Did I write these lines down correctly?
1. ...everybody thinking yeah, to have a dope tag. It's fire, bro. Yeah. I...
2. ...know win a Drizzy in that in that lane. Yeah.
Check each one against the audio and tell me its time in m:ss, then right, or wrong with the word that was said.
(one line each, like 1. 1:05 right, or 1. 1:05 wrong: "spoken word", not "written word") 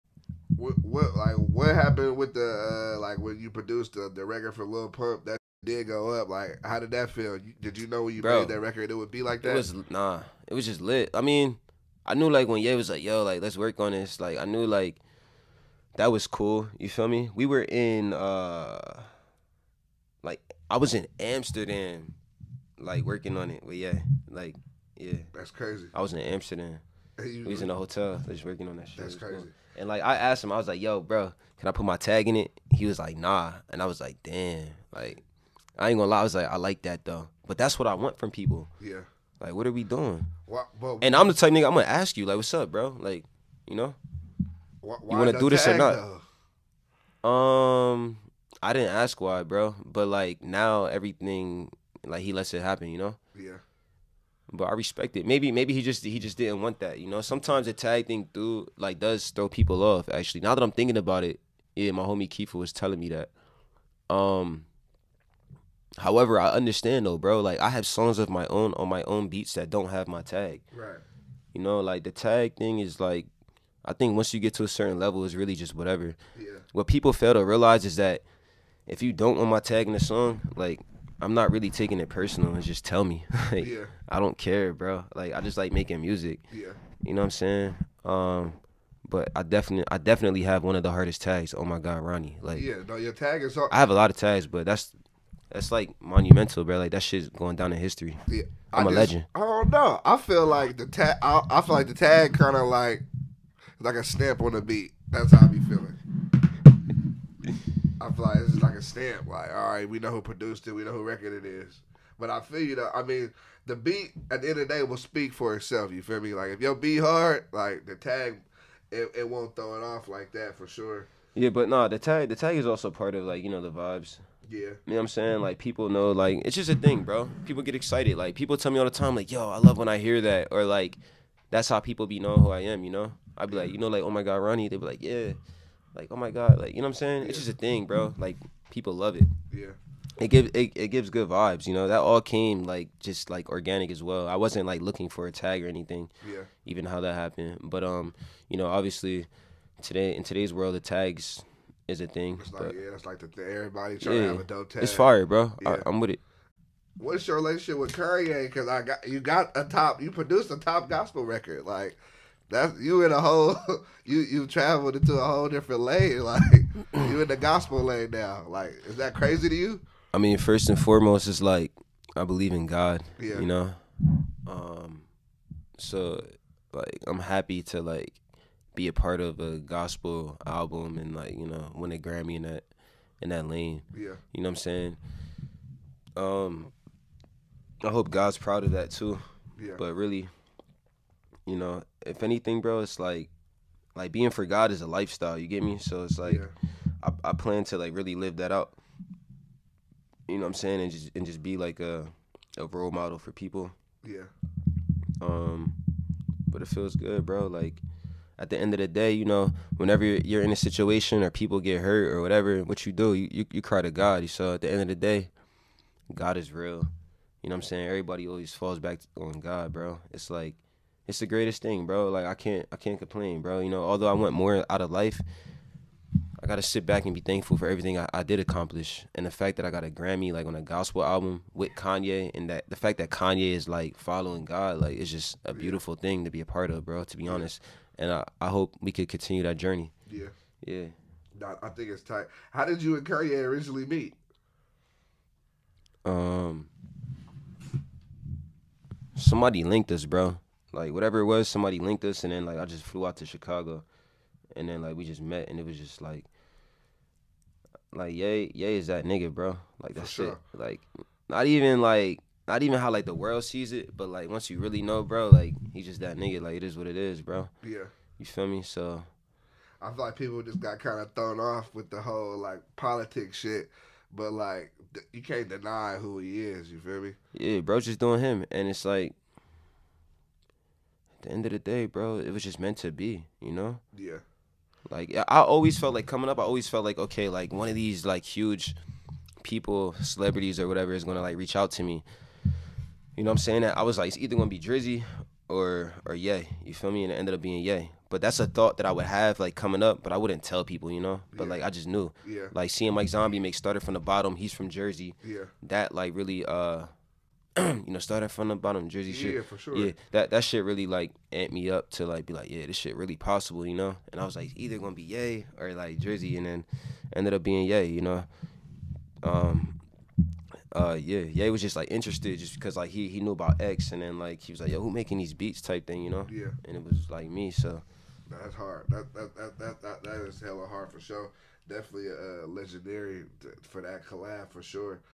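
1. 2:33 wrong: "trying", not "thinking"
2. 3:01 wrong: "Grammy", not "Drizzy".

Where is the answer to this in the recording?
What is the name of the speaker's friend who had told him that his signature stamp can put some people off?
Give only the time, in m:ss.
1:02.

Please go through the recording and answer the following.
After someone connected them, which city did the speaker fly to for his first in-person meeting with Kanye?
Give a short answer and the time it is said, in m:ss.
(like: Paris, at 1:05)
Chicago, at 4:13.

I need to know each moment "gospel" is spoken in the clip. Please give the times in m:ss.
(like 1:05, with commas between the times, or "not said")
2:40, 2:47, 2:59, 3:50.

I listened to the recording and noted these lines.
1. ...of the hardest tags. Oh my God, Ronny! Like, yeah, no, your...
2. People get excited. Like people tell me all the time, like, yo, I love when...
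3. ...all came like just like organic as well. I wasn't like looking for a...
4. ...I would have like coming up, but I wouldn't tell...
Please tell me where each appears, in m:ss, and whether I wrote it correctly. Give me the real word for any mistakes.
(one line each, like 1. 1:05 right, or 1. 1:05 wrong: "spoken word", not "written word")
1. 1:30 right
2. 2:07 right
3. 2:21 right
4. 4:58 right.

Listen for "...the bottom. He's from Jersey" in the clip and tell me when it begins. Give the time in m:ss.
5:03.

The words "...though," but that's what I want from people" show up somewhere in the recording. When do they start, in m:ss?
0:37.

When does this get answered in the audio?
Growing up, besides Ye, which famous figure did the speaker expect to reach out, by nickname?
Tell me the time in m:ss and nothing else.
4:54.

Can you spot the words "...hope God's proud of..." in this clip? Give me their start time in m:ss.
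3:07.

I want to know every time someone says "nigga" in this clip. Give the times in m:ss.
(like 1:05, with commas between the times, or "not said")
0:41, 4:19, 4:26.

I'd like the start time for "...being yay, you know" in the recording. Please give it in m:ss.
5:17.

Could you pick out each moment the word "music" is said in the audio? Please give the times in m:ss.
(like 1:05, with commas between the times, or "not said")
1:26.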